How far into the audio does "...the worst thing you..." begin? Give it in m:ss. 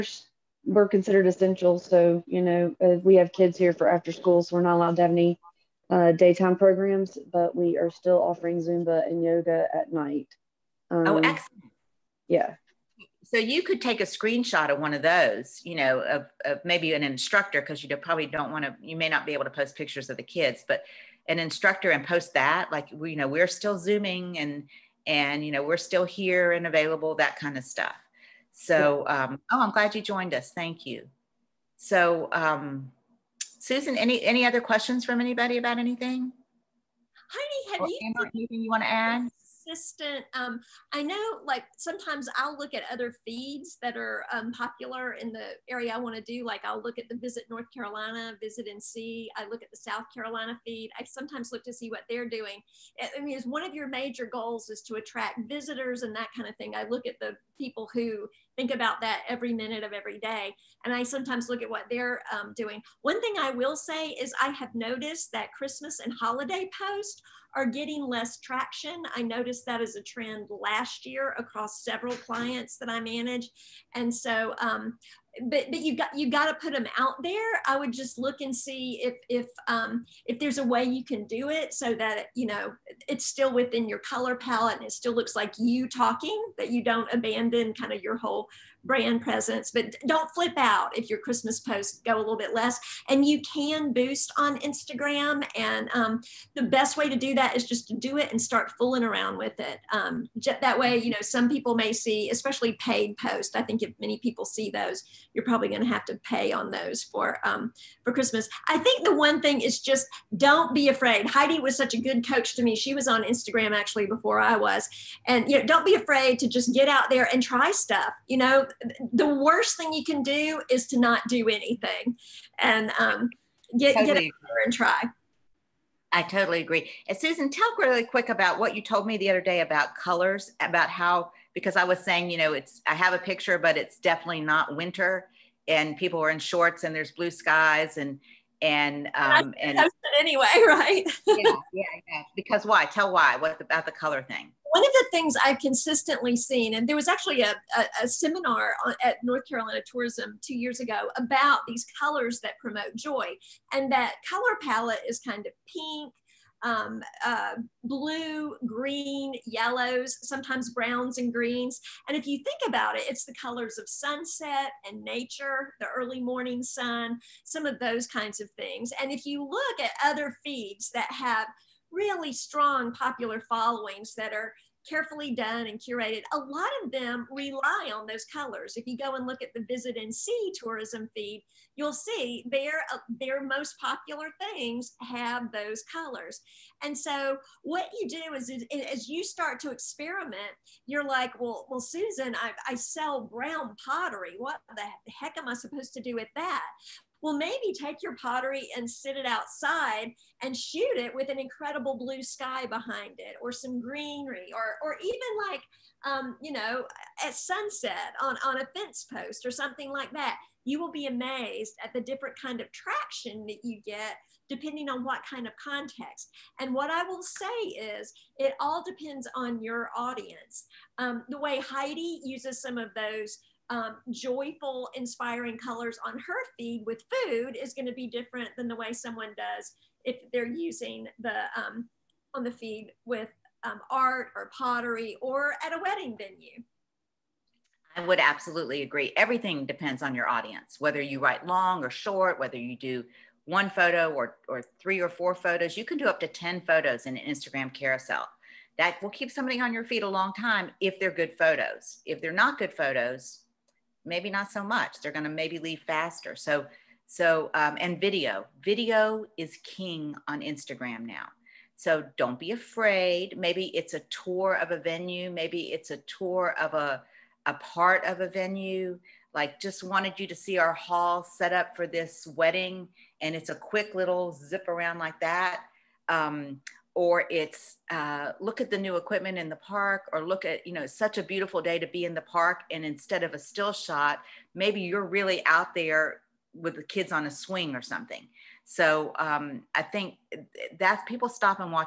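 1:59.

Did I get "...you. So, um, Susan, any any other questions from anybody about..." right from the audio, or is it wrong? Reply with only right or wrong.
right.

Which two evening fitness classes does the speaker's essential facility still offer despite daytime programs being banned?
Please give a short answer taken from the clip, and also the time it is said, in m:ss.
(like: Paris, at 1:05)
Zumba and yoga, at 0:08.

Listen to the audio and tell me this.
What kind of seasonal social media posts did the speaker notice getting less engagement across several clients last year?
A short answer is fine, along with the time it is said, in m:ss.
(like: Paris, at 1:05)
Christmas and holiday posts, at 1:05.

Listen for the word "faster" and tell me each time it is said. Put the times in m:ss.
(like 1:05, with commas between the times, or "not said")
4:15.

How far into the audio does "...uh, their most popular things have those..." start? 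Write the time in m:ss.
3:02.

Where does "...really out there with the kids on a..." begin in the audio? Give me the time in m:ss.
4:45.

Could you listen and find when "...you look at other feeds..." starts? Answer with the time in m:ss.
2:49.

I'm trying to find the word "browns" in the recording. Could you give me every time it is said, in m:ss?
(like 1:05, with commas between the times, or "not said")
2:40, 3:13.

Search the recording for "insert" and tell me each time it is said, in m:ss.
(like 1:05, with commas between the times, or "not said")
not said.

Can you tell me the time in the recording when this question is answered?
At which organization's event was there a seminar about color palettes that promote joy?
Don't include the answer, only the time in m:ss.
2:29.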